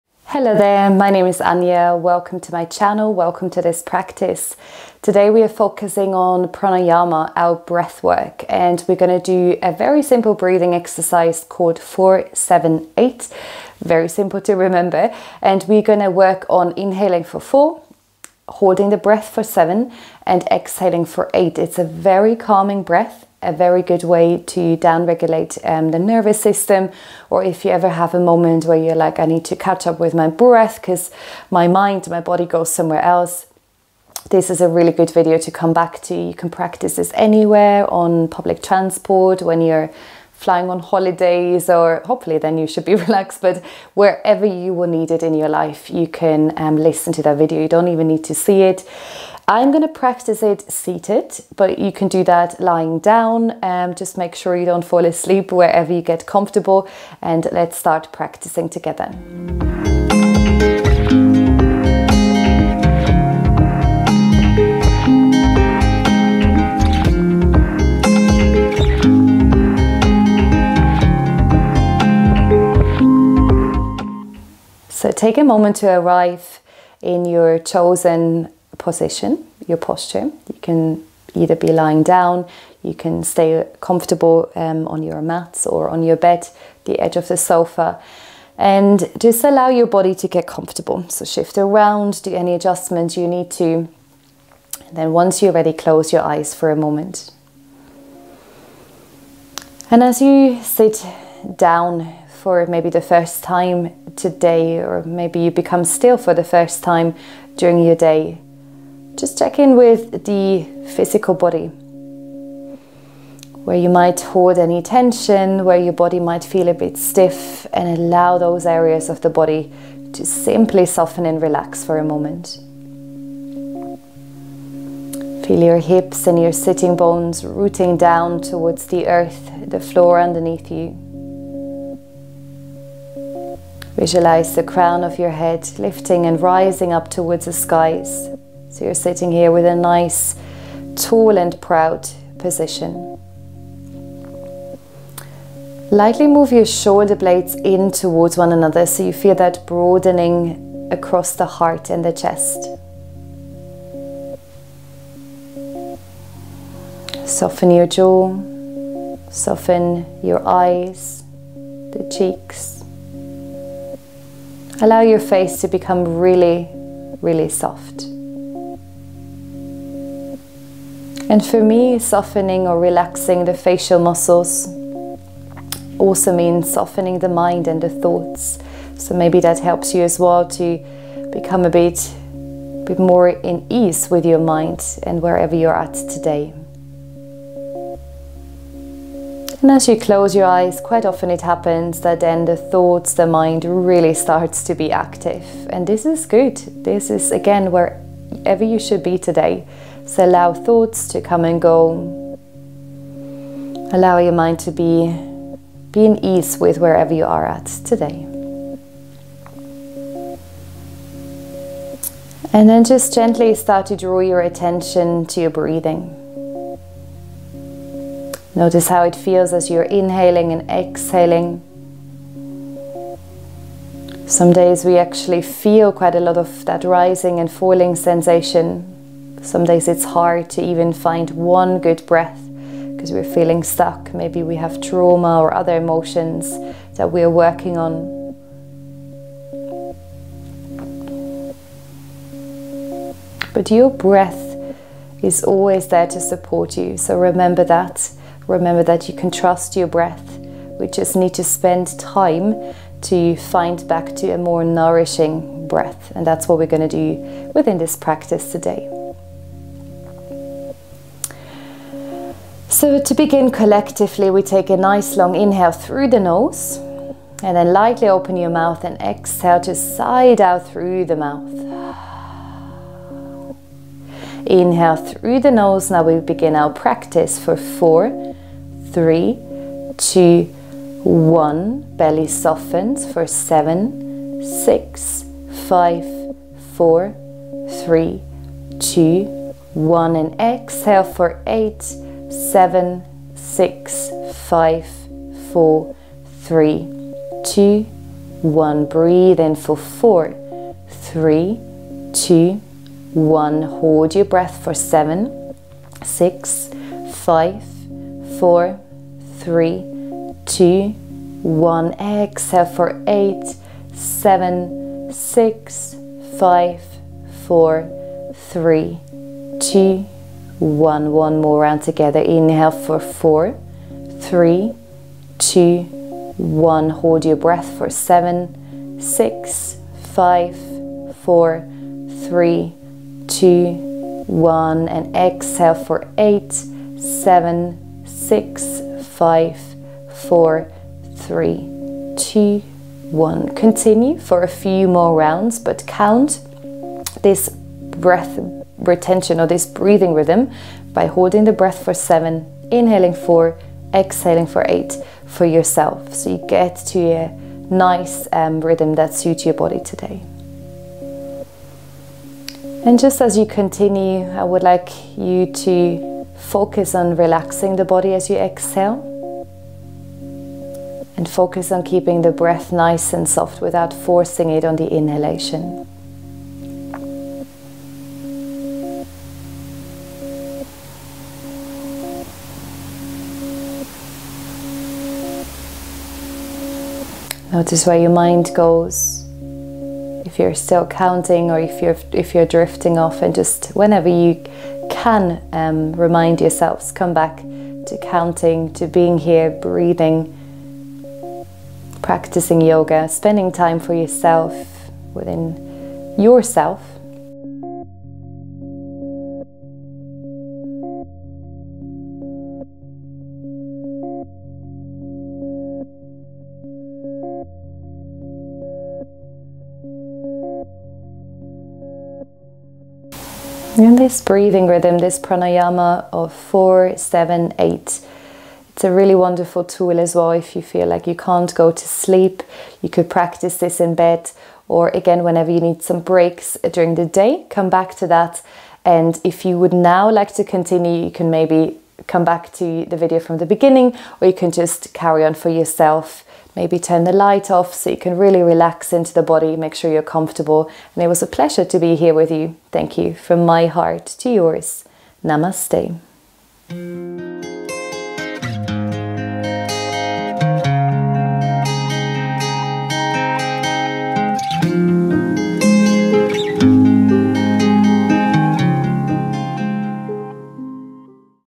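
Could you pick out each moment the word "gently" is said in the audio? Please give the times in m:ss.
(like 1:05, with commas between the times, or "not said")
3:33.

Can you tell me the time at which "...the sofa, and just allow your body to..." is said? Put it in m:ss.
1:27.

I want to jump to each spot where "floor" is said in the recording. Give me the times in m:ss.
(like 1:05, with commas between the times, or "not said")
2:09.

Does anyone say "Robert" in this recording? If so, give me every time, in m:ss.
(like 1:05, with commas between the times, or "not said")
not said.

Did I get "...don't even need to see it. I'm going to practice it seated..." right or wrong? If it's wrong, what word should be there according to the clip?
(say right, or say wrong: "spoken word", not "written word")
right.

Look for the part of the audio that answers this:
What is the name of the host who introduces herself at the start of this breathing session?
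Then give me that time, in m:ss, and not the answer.
0:01.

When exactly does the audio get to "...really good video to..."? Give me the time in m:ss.
0:34.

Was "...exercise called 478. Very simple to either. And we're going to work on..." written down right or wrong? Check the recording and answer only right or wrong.
wrong.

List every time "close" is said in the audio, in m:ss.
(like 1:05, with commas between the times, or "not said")
1:35, 3:09.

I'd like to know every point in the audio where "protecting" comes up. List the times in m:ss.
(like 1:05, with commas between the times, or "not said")
not said.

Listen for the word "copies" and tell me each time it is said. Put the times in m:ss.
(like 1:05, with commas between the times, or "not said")
not said.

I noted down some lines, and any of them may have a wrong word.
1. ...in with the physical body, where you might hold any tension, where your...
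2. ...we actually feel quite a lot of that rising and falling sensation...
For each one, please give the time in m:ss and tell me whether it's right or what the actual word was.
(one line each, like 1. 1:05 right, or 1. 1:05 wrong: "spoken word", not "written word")
1. 1:49 right
2. 3:44 right.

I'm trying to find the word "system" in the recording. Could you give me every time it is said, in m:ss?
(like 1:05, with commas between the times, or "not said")
0:26.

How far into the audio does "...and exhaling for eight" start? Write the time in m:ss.
0:20.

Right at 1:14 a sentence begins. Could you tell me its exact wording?
So take a moment to arrive in your chosen position, your posture.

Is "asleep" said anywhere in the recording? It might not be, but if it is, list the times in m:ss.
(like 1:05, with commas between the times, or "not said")
0:55.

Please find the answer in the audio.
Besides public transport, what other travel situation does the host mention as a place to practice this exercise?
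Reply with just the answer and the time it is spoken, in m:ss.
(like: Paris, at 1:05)
flying on holidays, at 0:40.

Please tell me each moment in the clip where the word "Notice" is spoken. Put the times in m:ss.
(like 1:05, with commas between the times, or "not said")
3:38, 6:27.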